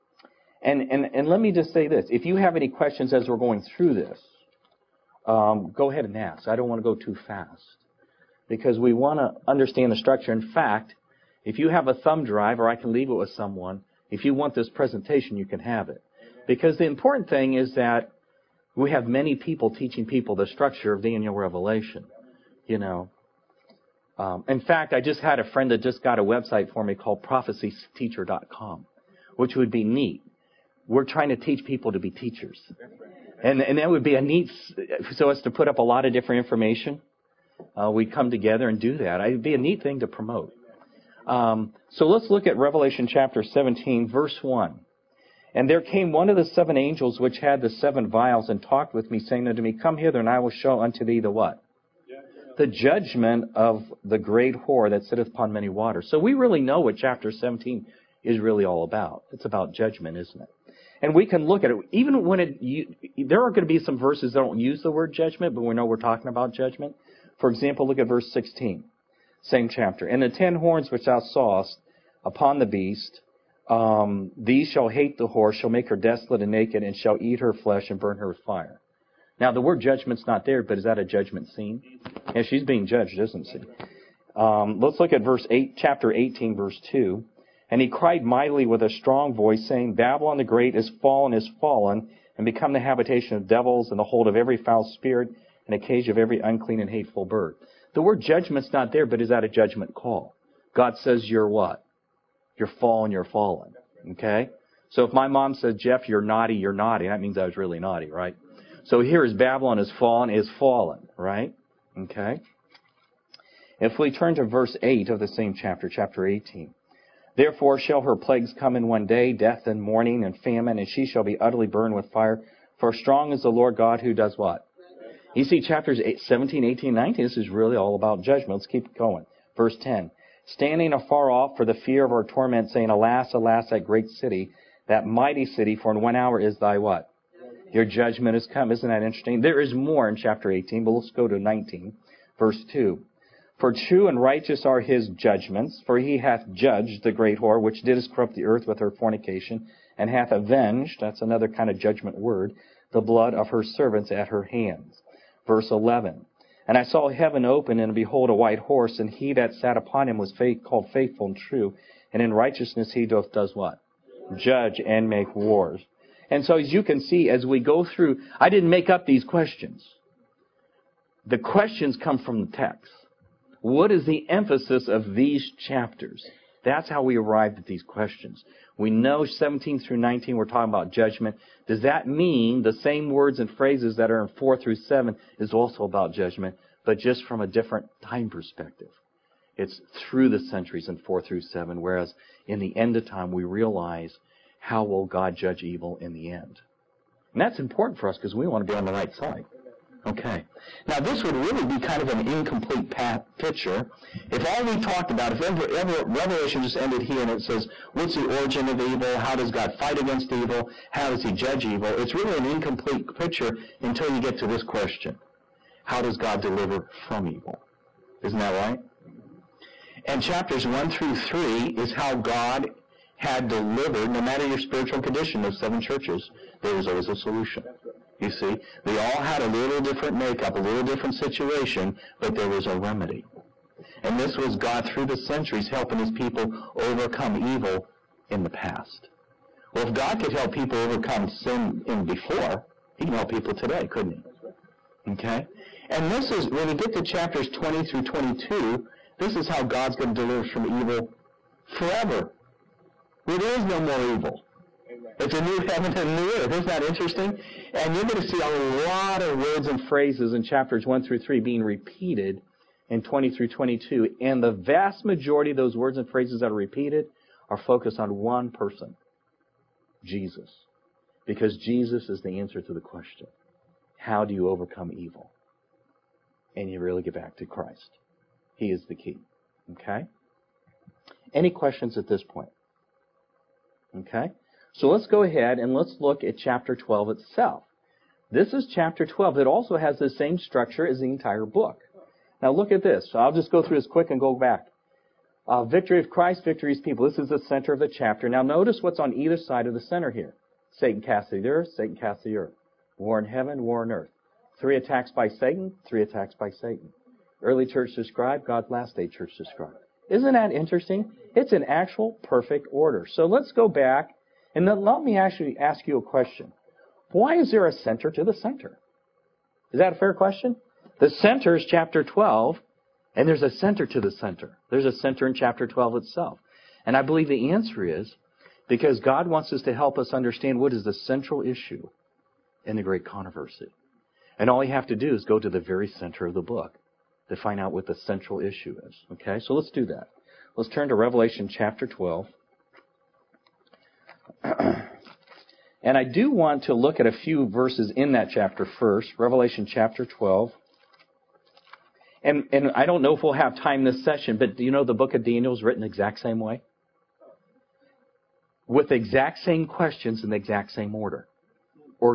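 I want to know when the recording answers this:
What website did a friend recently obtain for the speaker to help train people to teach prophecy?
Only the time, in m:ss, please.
0:27.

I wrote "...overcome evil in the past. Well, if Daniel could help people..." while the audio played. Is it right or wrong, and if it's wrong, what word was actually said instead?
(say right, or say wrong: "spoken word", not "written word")
wrong: "God", not "Daniel".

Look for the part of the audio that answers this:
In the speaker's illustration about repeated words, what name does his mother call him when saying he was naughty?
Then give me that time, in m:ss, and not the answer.
1:45.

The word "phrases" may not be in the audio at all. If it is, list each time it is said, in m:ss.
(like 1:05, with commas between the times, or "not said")
3:03, 4:19, 4:26.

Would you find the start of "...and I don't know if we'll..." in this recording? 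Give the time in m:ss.
5:52.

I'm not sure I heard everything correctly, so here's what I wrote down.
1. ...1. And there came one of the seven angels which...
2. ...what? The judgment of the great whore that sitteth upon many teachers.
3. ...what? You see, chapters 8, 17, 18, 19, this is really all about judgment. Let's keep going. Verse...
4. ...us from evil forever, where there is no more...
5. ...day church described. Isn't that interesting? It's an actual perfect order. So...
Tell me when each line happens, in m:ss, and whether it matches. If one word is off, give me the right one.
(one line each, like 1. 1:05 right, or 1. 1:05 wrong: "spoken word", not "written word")
1. 0:44 right
2. 0:51 wrong: "waters", not "teachers"
3. 2:04 right
4. 4:10 right
5. 5:08 right.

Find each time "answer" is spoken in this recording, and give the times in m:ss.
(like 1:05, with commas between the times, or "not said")
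4:32, 5:27.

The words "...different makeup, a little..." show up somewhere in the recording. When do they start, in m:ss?
3:49.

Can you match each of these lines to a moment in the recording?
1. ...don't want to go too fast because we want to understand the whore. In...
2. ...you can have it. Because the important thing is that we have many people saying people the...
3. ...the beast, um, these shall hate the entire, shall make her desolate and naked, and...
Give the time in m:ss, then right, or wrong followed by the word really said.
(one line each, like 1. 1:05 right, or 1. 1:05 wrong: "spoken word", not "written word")
1. 0:06 wrong: "structure", not "whore"
2. 0:15 wrong: "teaching", not "saying"
3. 1:12 wrong: "whore", not "entire".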